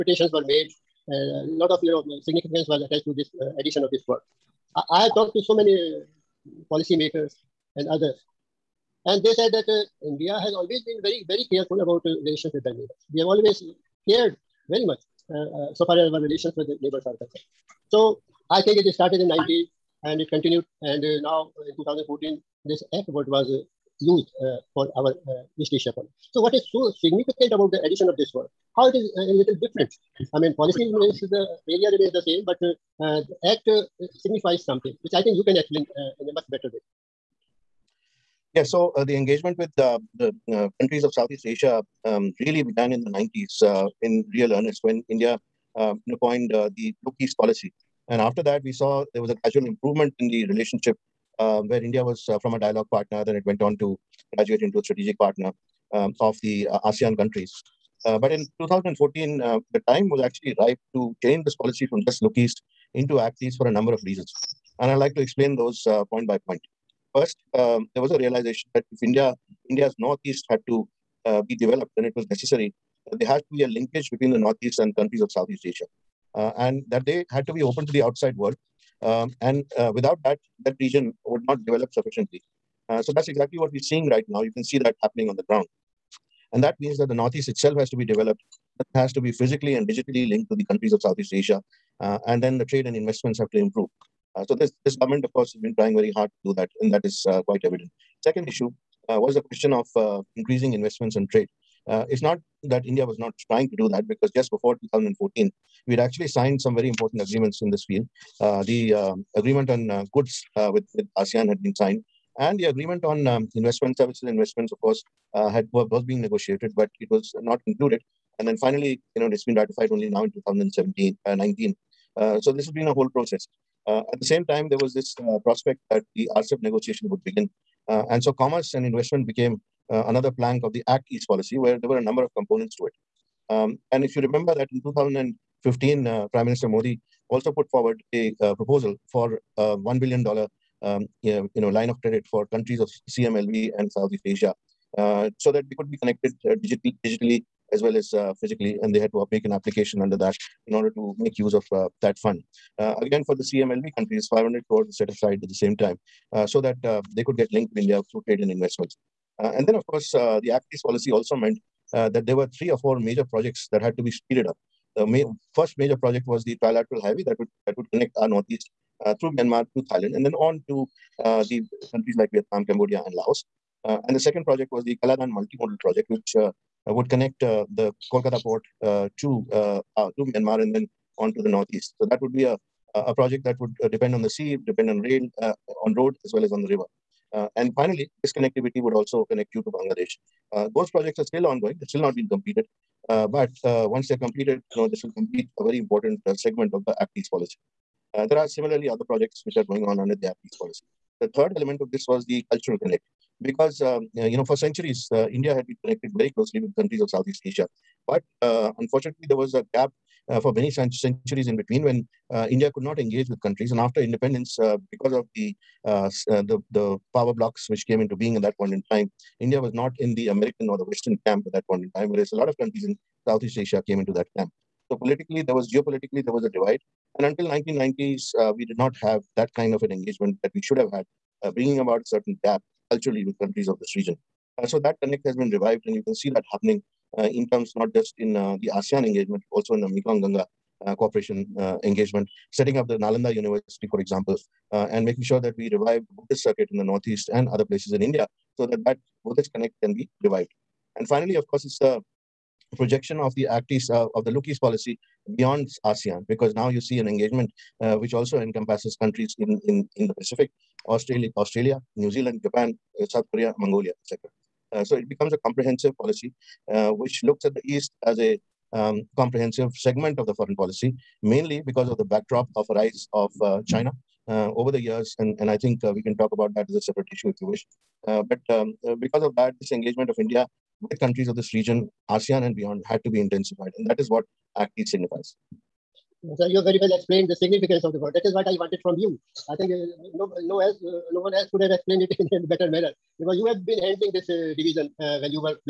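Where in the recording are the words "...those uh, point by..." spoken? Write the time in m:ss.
1:05.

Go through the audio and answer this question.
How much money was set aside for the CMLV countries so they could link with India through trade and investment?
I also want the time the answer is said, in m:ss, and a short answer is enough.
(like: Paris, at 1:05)
500 crores, at 2:34.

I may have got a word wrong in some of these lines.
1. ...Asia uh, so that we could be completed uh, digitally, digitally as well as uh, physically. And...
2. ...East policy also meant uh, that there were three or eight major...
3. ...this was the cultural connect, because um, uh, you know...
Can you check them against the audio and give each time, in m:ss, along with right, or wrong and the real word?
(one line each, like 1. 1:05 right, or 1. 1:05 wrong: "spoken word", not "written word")
1. 2:24 wrong: "connected", not "completed"
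2. 2:40 wrong: "four", not "eight"
3. 3:21 right.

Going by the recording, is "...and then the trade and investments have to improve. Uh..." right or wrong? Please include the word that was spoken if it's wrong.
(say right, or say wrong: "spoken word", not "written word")
right.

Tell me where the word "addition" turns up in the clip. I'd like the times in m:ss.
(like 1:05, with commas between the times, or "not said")
0:03, 0:27.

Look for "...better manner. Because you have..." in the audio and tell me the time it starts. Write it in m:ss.
4:52.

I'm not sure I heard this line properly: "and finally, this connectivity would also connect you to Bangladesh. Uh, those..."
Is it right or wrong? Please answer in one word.
right.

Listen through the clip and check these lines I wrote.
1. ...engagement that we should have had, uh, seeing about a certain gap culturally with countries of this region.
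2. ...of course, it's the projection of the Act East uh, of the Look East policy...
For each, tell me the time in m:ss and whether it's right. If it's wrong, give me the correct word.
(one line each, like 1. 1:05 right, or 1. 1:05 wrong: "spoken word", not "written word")
1. 3:49 wrong: "bringing", not "seeing"
2. 4:11 right.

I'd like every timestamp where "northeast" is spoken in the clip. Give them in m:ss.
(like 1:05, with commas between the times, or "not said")
1:09, 1:14, 1:27, 2:48, 3:01, 4:06.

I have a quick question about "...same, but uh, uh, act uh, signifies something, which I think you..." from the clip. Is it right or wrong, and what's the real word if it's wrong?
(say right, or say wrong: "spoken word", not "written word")
right.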